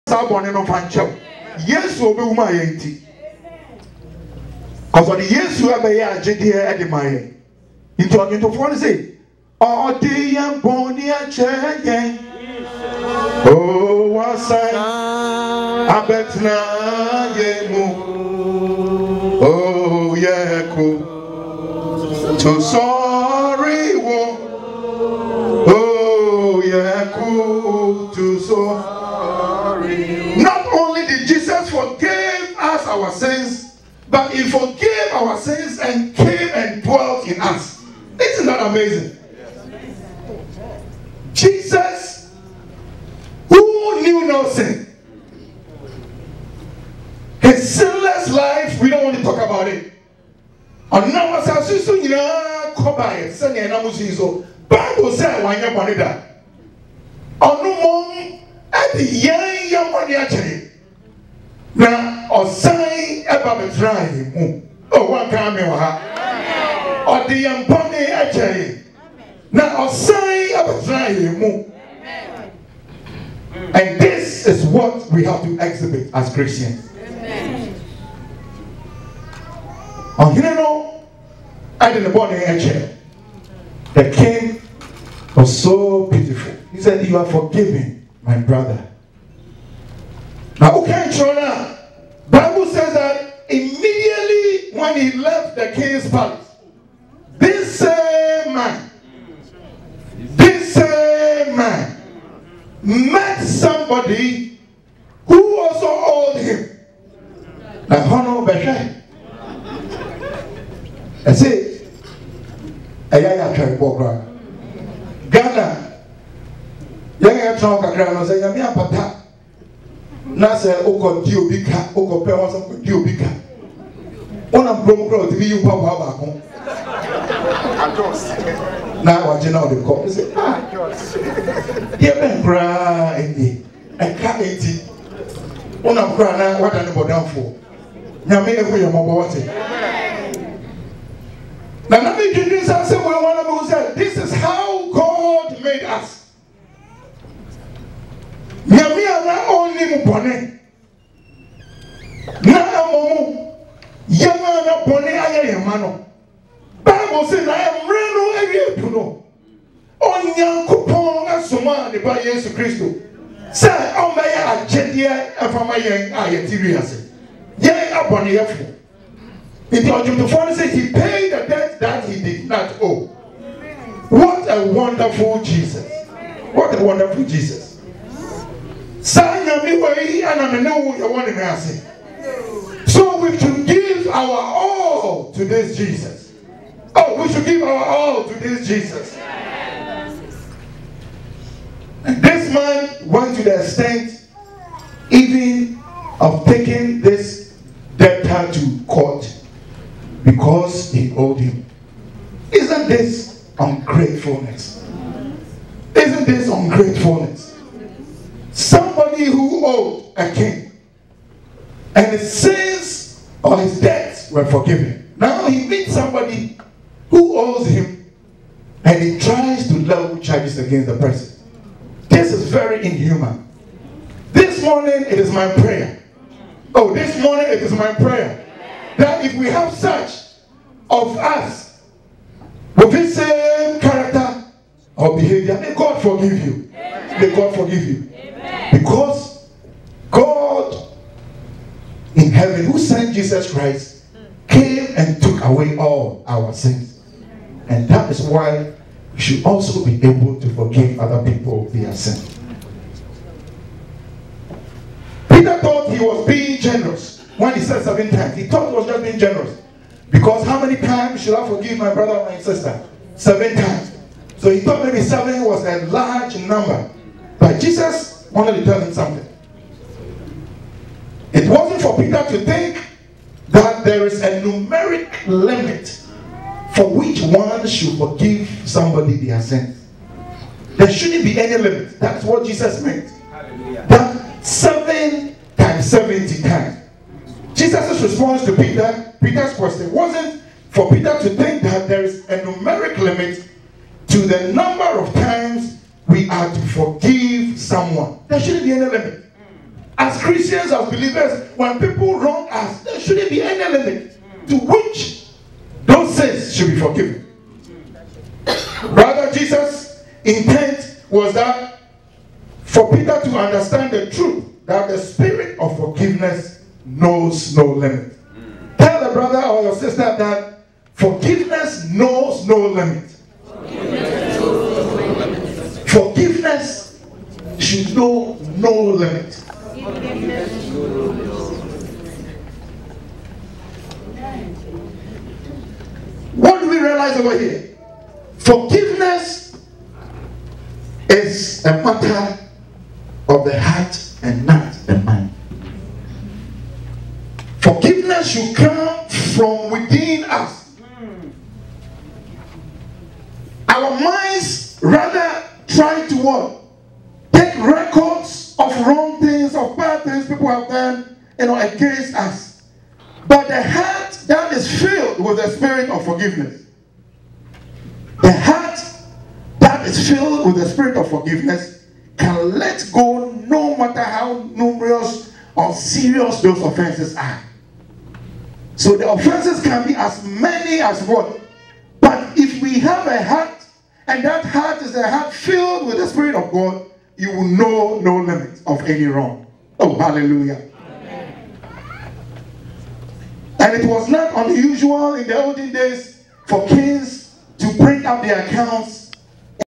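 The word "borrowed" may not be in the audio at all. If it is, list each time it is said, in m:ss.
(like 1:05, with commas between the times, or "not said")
not said.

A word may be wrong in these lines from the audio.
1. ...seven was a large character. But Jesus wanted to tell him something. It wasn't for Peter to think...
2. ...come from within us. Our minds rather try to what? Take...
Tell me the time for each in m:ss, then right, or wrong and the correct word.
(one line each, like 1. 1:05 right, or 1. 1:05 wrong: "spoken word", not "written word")
1. 4:24 wrong: "number", not "character"
2. 5:48 right.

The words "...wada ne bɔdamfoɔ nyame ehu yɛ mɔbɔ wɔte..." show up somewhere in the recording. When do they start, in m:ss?
2:16.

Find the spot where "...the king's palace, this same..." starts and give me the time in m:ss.
1:35.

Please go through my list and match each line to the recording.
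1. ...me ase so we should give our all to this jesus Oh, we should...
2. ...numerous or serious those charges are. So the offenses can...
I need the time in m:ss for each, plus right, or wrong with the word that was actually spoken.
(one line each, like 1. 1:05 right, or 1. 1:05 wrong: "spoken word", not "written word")
1. 3:01 right
2. 6:14 wrong: "offenses", not "charges".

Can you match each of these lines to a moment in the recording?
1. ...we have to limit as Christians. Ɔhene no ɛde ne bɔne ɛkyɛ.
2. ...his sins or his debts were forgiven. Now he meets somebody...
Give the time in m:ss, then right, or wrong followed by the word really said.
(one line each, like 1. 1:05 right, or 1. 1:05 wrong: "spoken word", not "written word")
1. 1:15 wrong: "exhibit", not "limit"
2. 3:32 right.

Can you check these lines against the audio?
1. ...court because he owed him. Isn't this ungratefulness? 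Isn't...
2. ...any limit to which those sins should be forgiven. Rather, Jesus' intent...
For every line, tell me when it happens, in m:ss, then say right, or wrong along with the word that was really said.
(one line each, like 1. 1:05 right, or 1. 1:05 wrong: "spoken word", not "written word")
1. 3:18 right
2. 5:03 right.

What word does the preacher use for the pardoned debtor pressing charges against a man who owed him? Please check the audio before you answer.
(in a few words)
Inhuman.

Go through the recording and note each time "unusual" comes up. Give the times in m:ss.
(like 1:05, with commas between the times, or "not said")
6:34.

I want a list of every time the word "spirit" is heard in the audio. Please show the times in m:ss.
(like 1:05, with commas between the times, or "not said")
5:14, 6:05, 6:10, 6:26.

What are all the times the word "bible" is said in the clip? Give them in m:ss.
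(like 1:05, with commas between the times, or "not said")
0:54, 1:32.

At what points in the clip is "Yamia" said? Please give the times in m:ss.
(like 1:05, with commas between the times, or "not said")
1:58.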